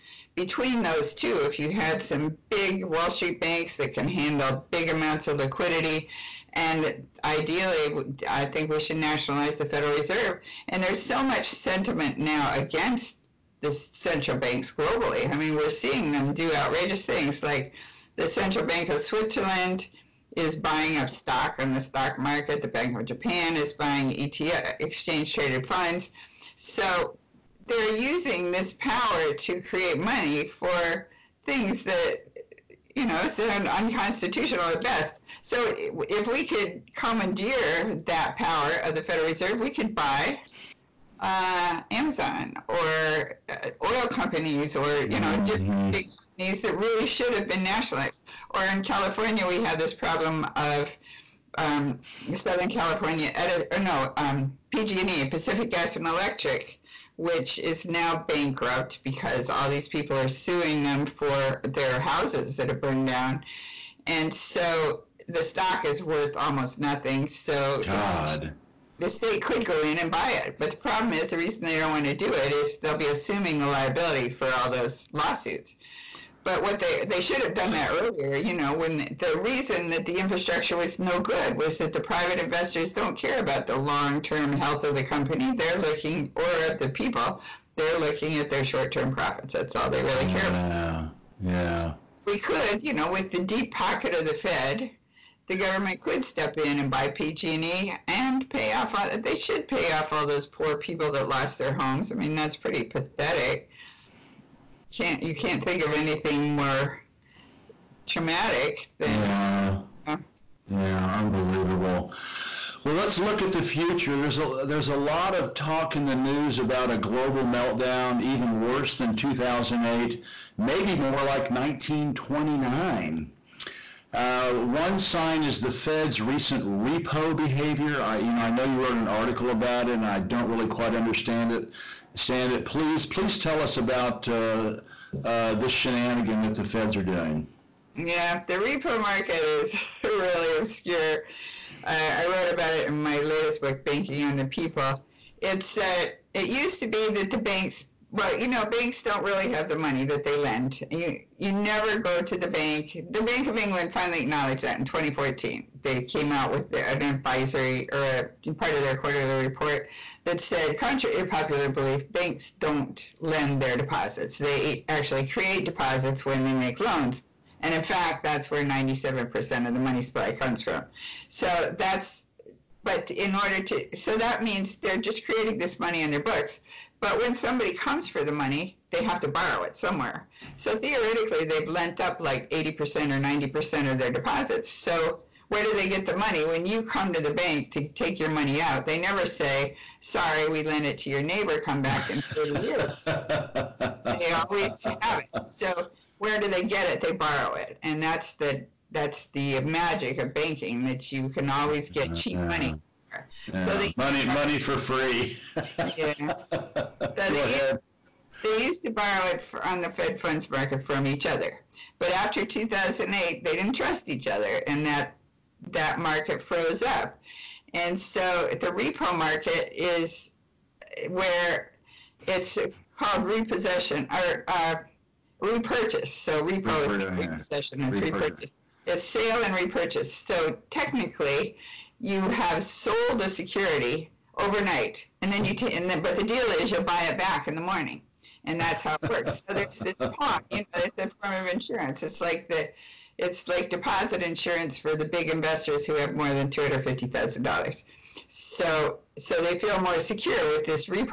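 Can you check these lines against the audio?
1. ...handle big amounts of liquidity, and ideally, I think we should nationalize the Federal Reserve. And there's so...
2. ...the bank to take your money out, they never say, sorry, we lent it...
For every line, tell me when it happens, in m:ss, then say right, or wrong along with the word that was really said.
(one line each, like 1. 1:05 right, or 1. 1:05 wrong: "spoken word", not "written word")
1. 0:04 right
2. 3:07 right.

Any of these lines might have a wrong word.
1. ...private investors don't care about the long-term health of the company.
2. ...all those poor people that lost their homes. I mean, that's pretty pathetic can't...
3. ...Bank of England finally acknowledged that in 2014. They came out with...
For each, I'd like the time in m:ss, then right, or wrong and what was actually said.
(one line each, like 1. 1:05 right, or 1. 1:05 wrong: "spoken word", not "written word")
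1. 1:22 right
2. 1:40 right
3. 2:33 right.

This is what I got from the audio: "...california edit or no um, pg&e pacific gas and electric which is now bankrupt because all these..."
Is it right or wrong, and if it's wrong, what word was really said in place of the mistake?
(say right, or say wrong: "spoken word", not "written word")
right.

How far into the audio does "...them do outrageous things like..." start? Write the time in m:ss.
0:16.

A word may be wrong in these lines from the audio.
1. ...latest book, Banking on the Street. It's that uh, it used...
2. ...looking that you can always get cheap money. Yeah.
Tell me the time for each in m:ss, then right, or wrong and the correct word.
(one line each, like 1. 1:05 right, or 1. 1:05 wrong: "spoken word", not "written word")
1. 2:23 wrong: "People", not "Street"
2. 3:20 wrong: "banking", not "looking".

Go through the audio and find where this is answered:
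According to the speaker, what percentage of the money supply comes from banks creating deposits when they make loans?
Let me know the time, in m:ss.
2:48.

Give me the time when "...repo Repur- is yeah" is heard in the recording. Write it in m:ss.
3:46.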